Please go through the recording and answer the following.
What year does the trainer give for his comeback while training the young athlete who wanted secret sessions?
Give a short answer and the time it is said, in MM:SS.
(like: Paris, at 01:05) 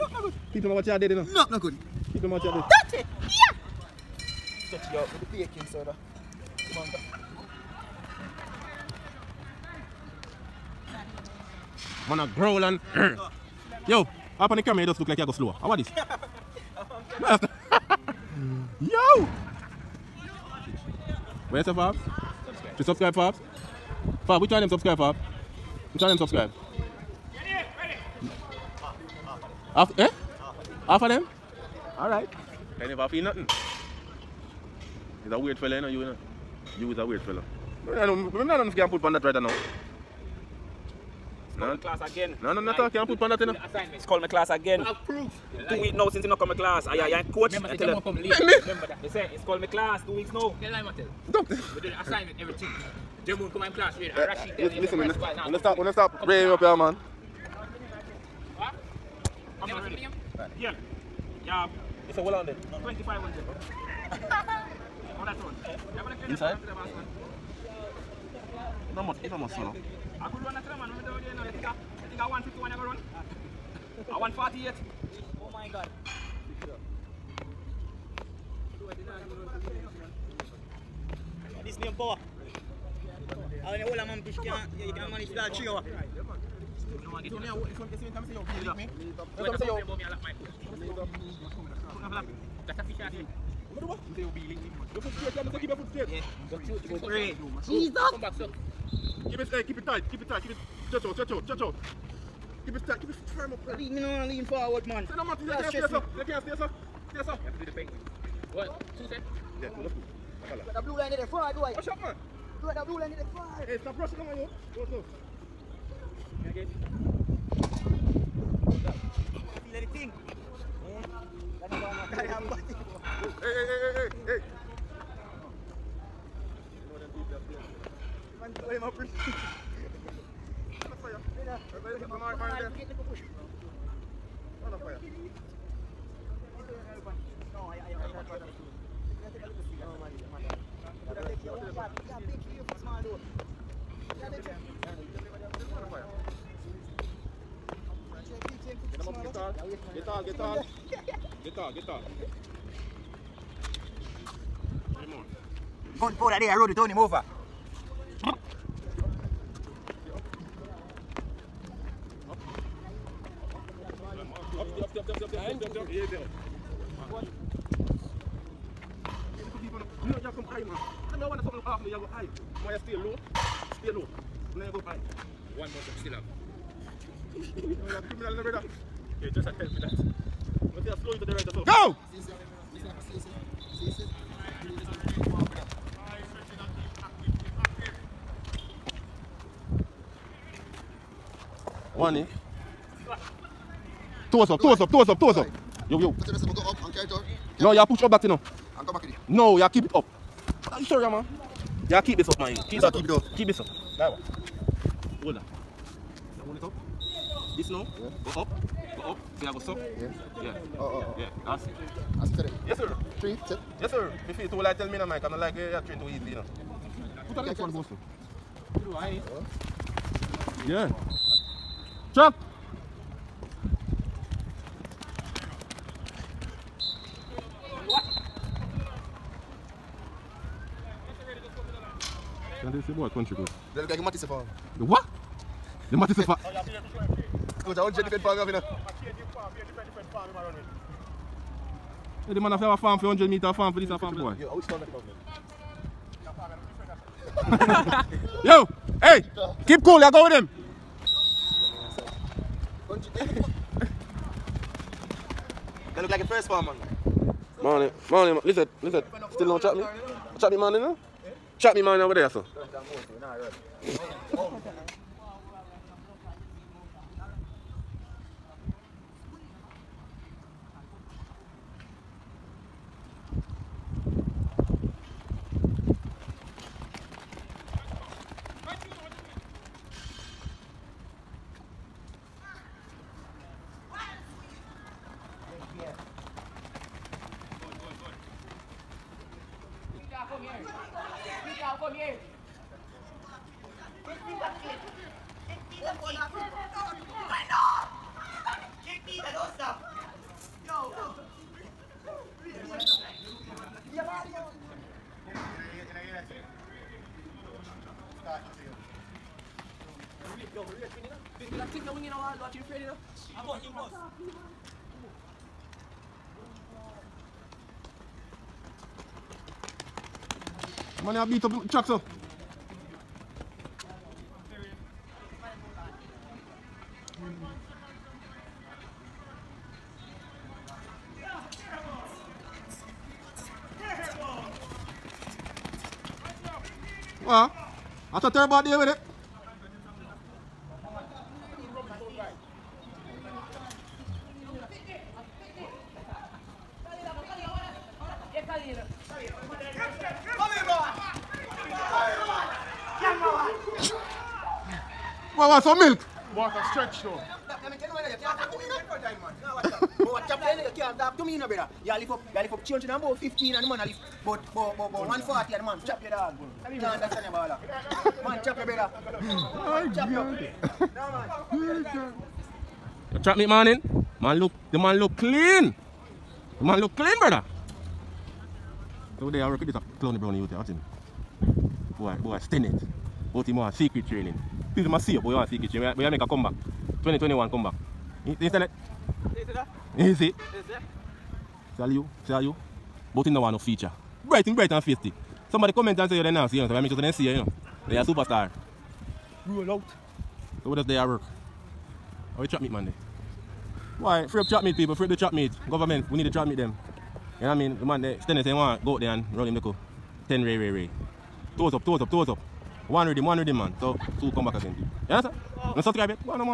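2021, at 06:27.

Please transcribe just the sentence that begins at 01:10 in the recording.
I could run a three man.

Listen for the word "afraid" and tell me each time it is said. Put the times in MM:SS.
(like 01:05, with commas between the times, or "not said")
05:12.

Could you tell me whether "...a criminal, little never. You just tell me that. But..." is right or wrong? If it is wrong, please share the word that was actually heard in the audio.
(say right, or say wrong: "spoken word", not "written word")
wrong: "brother", not "never".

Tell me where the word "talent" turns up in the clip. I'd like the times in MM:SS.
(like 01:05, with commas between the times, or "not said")
not said.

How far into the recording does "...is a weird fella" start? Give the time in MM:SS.
00:36.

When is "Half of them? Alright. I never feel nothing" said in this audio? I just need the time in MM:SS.
00:30.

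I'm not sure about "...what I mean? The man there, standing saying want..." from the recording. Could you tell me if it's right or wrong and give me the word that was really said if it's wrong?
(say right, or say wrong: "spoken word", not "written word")
right.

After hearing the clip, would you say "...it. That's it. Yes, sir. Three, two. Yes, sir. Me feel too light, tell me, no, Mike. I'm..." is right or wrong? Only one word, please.
right.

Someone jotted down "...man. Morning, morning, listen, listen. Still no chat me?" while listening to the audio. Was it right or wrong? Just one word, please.
right.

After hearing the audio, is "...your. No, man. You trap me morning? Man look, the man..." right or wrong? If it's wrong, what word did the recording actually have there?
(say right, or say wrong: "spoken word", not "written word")
right.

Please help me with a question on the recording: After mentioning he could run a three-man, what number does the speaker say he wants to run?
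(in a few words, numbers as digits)
48.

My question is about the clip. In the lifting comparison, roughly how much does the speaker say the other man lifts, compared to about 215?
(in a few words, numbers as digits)
140.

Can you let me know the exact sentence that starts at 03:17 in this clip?
No, you push up that, you know.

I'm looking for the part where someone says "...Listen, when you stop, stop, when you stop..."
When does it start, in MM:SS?
00:54.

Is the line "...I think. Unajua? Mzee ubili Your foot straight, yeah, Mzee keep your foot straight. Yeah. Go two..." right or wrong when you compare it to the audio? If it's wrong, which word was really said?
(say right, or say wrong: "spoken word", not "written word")
right.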